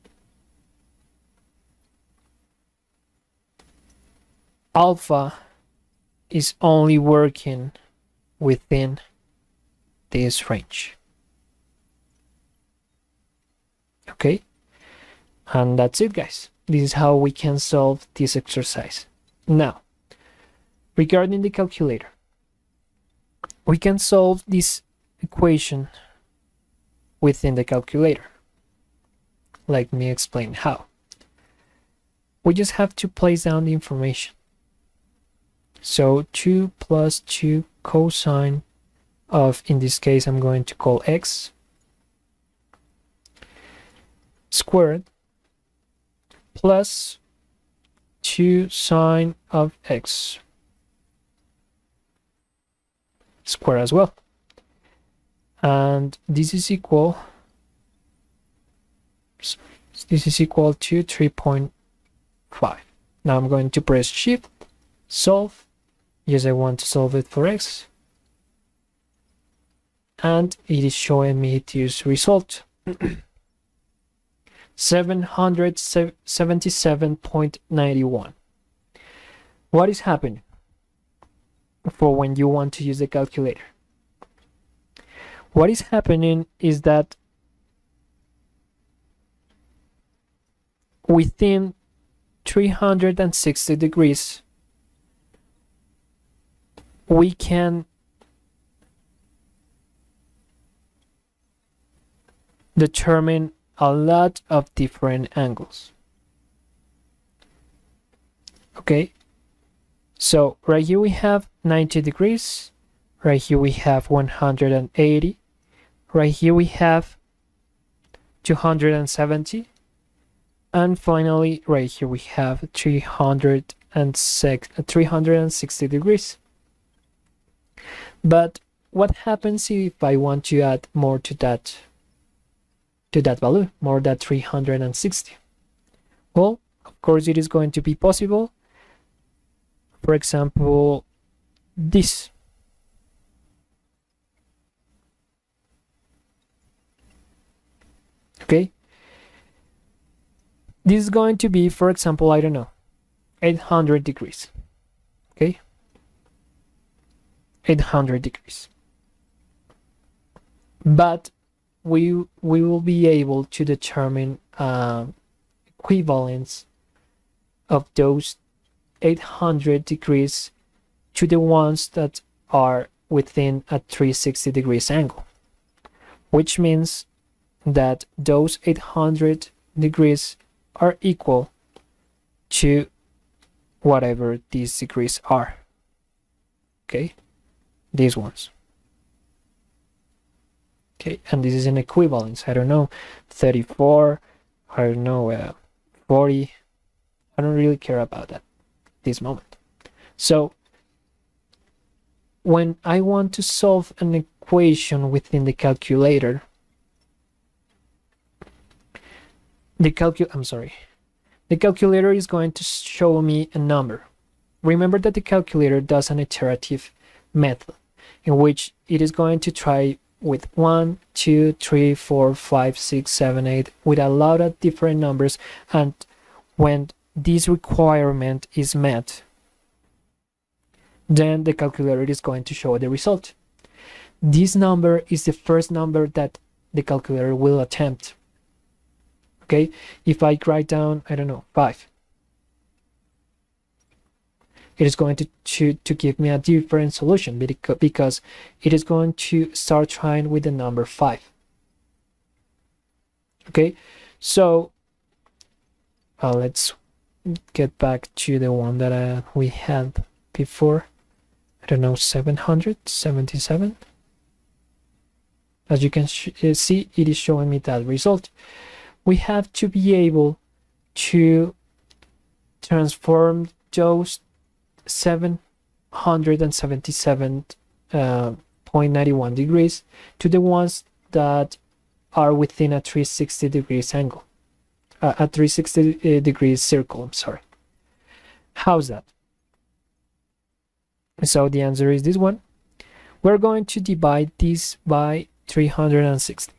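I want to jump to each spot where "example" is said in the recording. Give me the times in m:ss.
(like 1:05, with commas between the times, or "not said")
2:20, 2:31.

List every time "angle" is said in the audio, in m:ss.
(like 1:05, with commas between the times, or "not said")
1:45, 2:54, 4:43.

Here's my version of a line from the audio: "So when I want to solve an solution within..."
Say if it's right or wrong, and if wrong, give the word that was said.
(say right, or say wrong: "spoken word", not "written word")
wrong: "equation", not "solution".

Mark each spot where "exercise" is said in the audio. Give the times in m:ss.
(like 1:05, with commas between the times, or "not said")
0:18.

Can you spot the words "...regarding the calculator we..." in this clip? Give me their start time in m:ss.
0:20.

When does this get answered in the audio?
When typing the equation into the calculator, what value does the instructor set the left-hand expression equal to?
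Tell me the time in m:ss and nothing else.
1:01.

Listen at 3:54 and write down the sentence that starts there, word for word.
This number is the first number that the calculator will attempt.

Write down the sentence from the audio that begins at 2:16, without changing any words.
Well, of course it is going to be possible.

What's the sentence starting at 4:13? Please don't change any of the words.
Okay, so uh, let's get back to the one that uh, we had before.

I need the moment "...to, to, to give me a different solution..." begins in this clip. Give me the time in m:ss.
4:05.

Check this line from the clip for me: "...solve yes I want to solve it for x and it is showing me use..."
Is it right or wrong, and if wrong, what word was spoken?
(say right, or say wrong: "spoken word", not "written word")
right.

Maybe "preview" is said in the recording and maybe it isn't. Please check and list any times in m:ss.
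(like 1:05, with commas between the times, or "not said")
not said.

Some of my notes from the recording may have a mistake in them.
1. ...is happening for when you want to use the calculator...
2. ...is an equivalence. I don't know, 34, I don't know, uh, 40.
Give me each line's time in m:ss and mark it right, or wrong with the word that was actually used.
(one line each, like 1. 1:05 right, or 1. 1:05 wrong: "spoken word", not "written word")
1. 1:19 right
2. 3:11 right.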